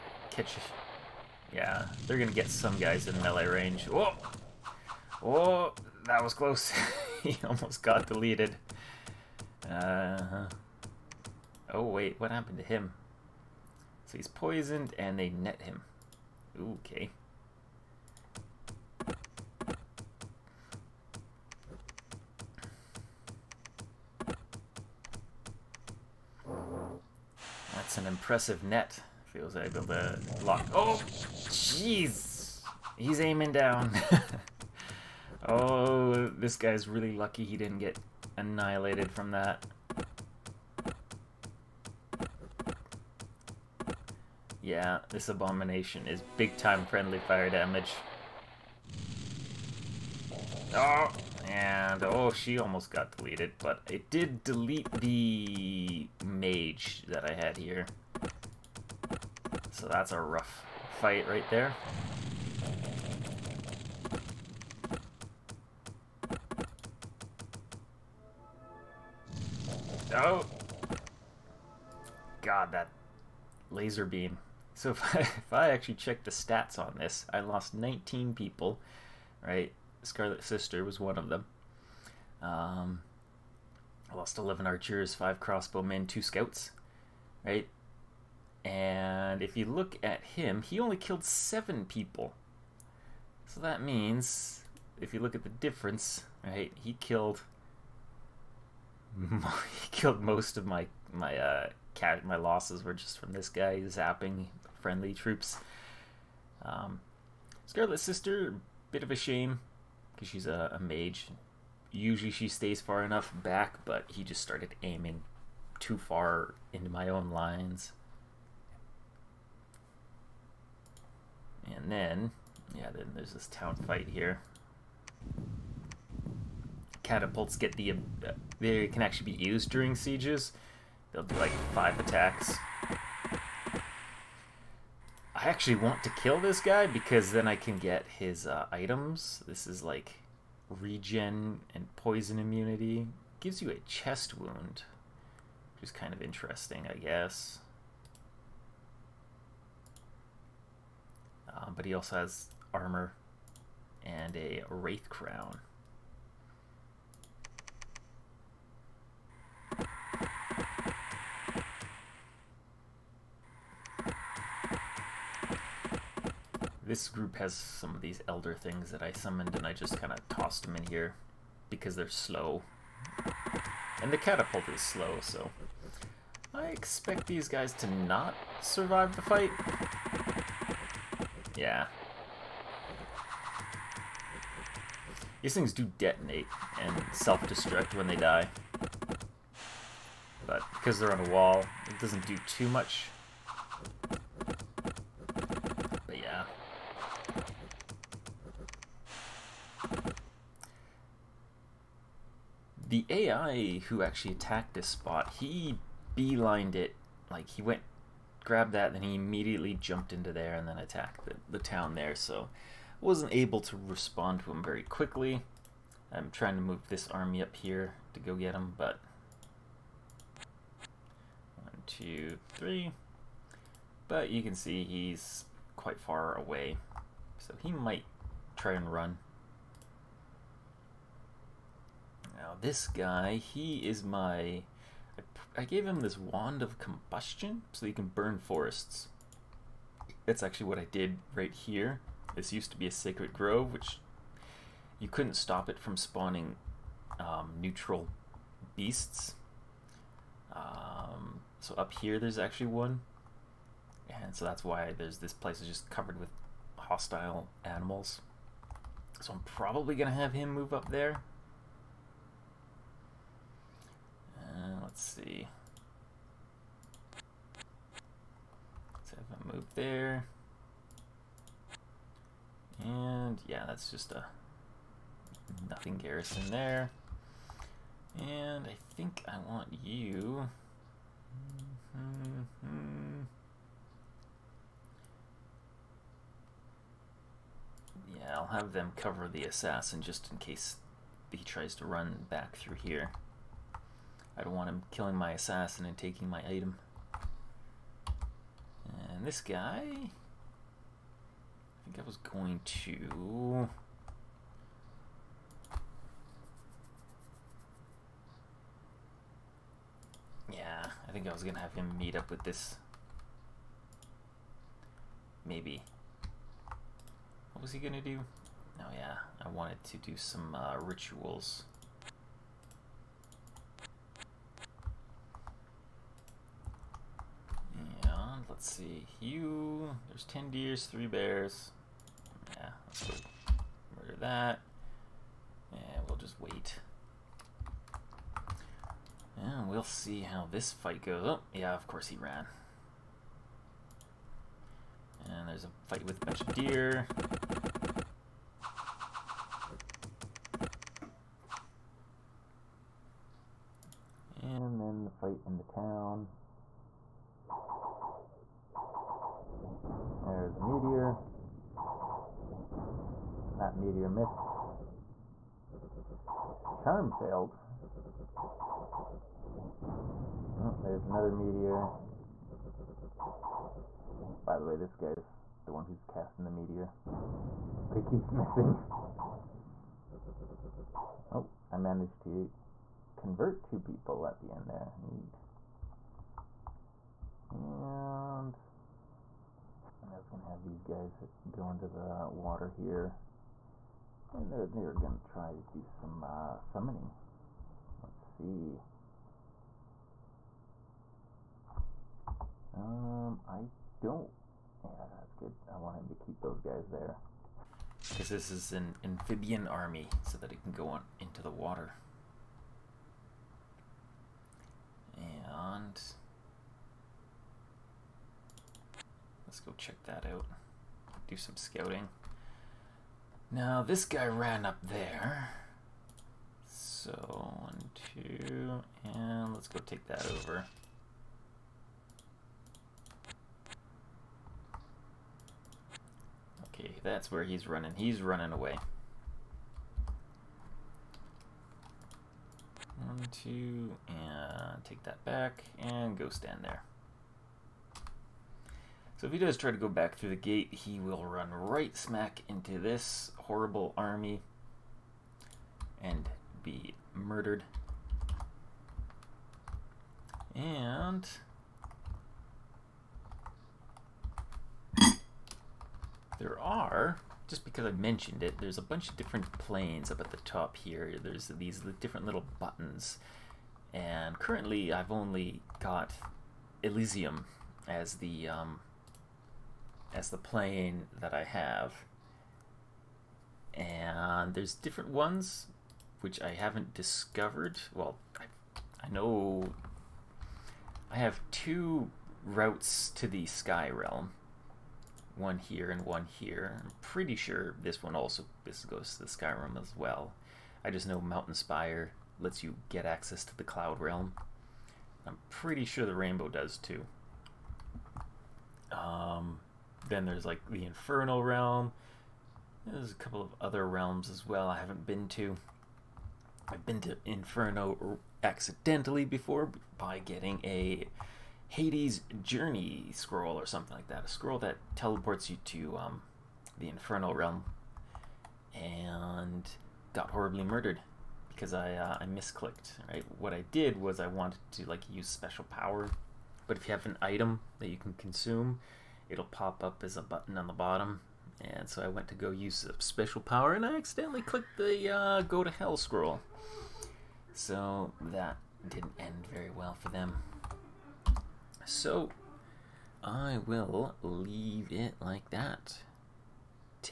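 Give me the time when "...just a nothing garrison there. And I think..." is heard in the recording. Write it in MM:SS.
04:33.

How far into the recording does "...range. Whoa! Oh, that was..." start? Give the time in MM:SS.
00:03.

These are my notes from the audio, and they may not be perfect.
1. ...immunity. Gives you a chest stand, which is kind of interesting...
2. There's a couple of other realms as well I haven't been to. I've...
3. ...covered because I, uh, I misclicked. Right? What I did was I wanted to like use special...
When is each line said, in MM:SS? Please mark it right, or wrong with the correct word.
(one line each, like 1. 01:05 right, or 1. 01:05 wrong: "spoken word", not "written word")
1. 02:22 wrong: "wound", not "stand"
2. 08:32 right
3. 08:50 wrong: "murdered", not "covered".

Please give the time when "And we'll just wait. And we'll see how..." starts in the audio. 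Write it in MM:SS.
05:35.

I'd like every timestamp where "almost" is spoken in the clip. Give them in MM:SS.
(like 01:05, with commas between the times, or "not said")
00:07, 00:52.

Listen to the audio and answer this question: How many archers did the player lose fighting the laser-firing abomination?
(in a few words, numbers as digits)
11.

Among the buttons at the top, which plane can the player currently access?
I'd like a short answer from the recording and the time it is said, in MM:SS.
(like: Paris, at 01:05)
Elysium, at 07:56.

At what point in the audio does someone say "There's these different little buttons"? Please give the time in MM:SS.
07:51.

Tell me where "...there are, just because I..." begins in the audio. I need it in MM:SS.
07:46.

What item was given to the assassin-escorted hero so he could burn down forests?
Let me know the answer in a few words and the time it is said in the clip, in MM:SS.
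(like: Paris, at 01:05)
Wand of combustion, at 03:56.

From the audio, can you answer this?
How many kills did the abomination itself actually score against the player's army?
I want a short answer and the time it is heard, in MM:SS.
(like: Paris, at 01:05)
7, at 01:31.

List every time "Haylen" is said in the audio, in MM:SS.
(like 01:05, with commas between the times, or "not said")
not said.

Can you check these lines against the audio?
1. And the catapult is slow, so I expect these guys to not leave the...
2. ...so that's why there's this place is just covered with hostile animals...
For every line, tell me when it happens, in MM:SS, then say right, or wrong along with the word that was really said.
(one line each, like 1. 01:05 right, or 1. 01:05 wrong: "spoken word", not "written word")
1. 02:54 wrong: "survive", not "leave"
2. 04:14 right.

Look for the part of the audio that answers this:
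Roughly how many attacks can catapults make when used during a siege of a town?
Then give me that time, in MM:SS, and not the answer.
02:11.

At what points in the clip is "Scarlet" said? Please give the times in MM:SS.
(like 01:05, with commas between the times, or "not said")
01:20, 01:47.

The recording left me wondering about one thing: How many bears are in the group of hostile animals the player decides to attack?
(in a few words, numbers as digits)
3.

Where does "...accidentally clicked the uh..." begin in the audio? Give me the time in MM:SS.
09:03.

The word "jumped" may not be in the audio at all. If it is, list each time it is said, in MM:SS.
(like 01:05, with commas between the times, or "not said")
03:29.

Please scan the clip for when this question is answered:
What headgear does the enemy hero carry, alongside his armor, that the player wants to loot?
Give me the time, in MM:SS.
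02:34.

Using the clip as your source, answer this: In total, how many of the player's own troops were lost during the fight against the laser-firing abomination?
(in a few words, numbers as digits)
19.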